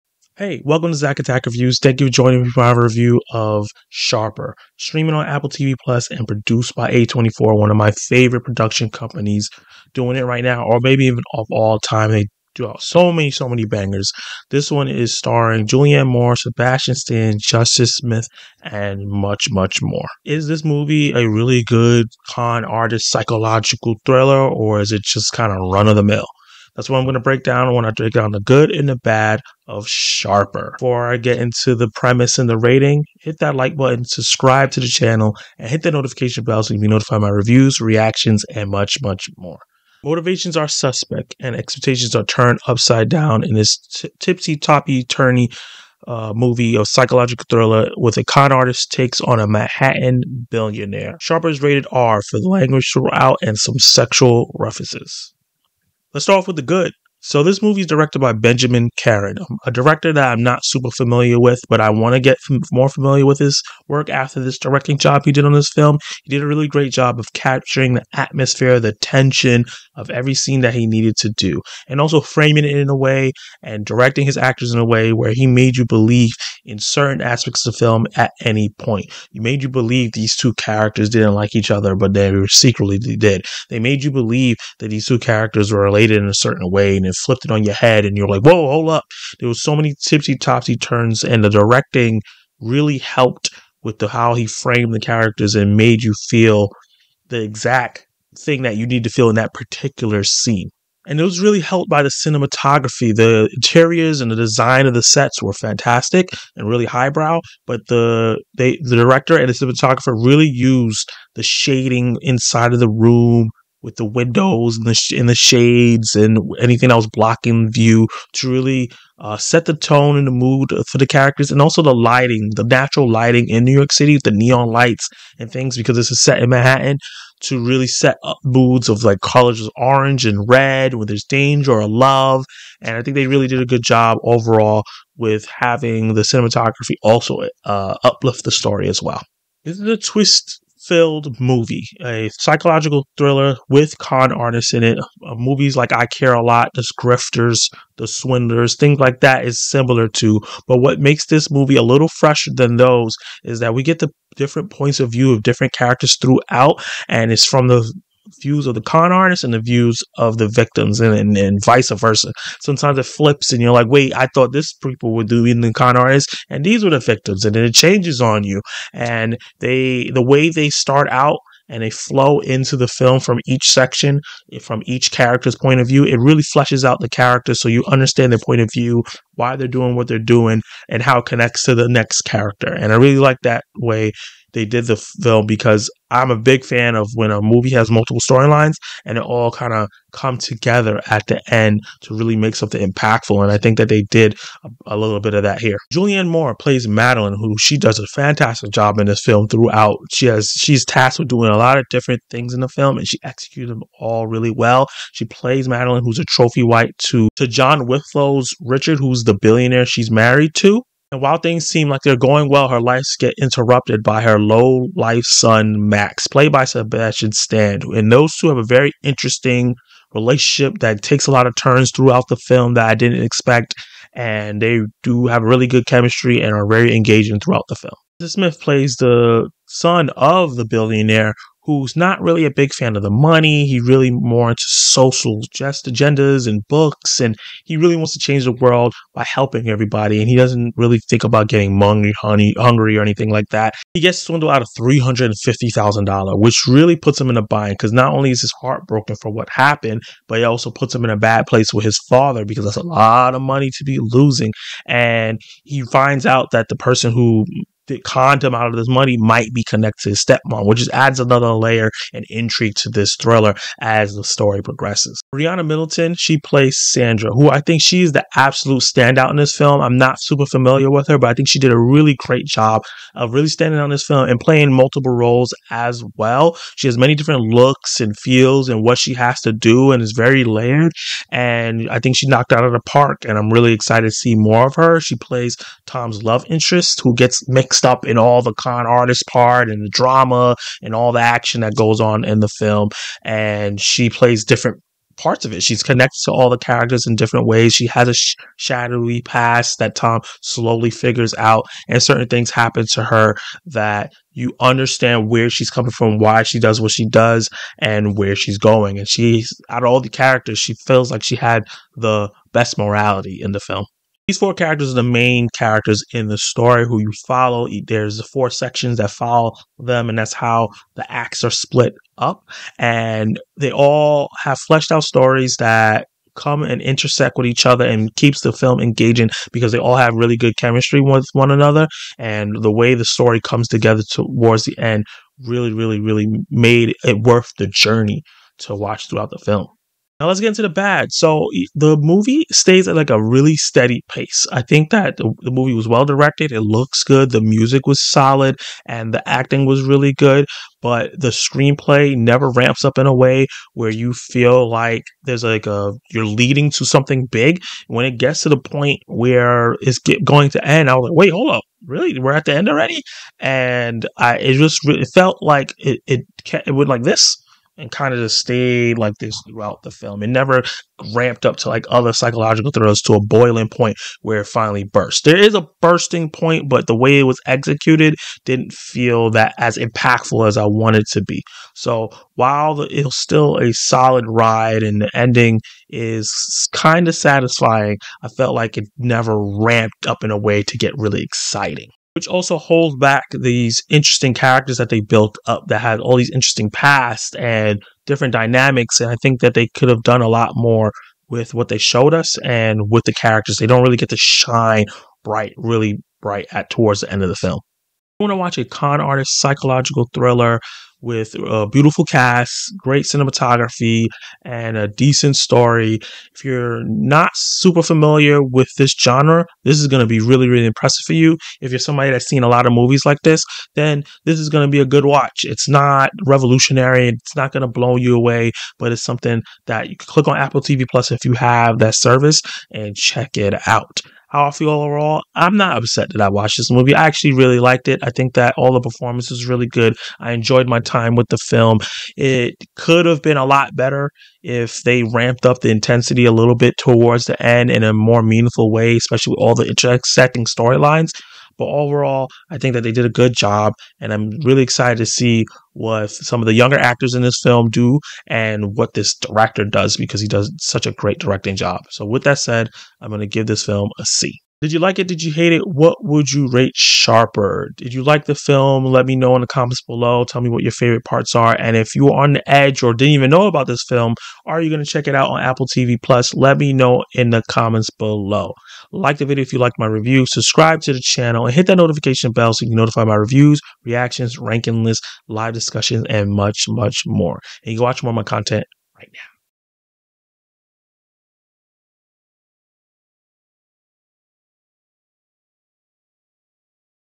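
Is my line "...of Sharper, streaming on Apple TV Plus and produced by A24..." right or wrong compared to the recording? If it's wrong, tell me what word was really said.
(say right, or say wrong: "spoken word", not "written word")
right.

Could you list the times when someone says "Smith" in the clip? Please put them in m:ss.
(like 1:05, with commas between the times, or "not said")
0:17, 3:48.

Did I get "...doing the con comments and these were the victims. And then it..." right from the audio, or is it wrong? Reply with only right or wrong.
wrong.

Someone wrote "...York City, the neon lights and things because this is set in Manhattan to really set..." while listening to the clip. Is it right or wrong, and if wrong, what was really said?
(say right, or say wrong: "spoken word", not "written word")
right.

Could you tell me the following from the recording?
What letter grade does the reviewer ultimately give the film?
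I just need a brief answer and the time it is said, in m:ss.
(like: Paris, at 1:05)
C, at 7:44.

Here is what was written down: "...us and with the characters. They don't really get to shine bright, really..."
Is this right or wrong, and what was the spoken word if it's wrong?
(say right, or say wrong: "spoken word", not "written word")
right.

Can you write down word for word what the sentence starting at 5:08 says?
And she's out of all the characters, she feels like she had the best morality in the film.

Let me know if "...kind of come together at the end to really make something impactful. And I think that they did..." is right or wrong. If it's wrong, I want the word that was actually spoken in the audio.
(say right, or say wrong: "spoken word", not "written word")
right.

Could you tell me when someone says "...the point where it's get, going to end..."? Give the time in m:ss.
5:58.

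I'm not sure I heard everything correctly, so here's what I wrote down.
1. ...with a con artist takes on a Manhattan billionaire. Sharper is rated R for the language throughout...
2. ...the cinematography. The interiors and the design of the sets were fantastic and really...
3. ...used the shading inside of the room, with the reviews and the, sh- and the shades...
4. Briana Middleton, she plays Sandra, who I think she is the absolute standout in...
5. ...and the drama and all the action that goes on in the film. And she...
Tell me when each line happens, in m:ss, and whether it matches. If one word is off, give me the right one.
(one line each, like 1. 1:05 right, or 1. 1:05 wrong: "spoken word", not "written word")
1. 0:47 right
2. 1:42 right
3. 1:50 wrong: "windows", not "reviews"
4. 4:25 right
5. 4:49 right.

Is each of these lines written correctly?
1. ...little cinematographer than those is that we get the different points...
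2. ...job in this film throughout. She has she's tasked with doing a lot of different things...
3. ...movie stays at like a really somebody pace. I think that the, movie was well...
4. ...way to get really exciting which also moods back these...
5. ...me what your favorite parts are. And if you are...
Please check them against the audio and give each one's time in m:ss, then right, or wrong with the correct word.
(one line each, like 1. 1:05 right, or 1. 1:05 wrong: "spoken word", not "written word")
1. 2:31 wrong: "fresher", not "cinematographer"
2. 3:18 right
3. 5:41 wrong: "steady", not "somebody"
4. 6:30 wrong: "holds", not "moods"
5. 7:50 right.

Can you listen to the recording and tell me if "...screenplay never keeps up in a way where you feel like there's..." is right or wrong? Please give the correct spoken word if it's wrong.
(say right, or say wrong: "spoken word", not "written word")
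wrong: "ramps", not "keeps".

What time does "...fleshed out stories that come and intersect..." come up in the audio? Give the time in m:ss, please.
5:24.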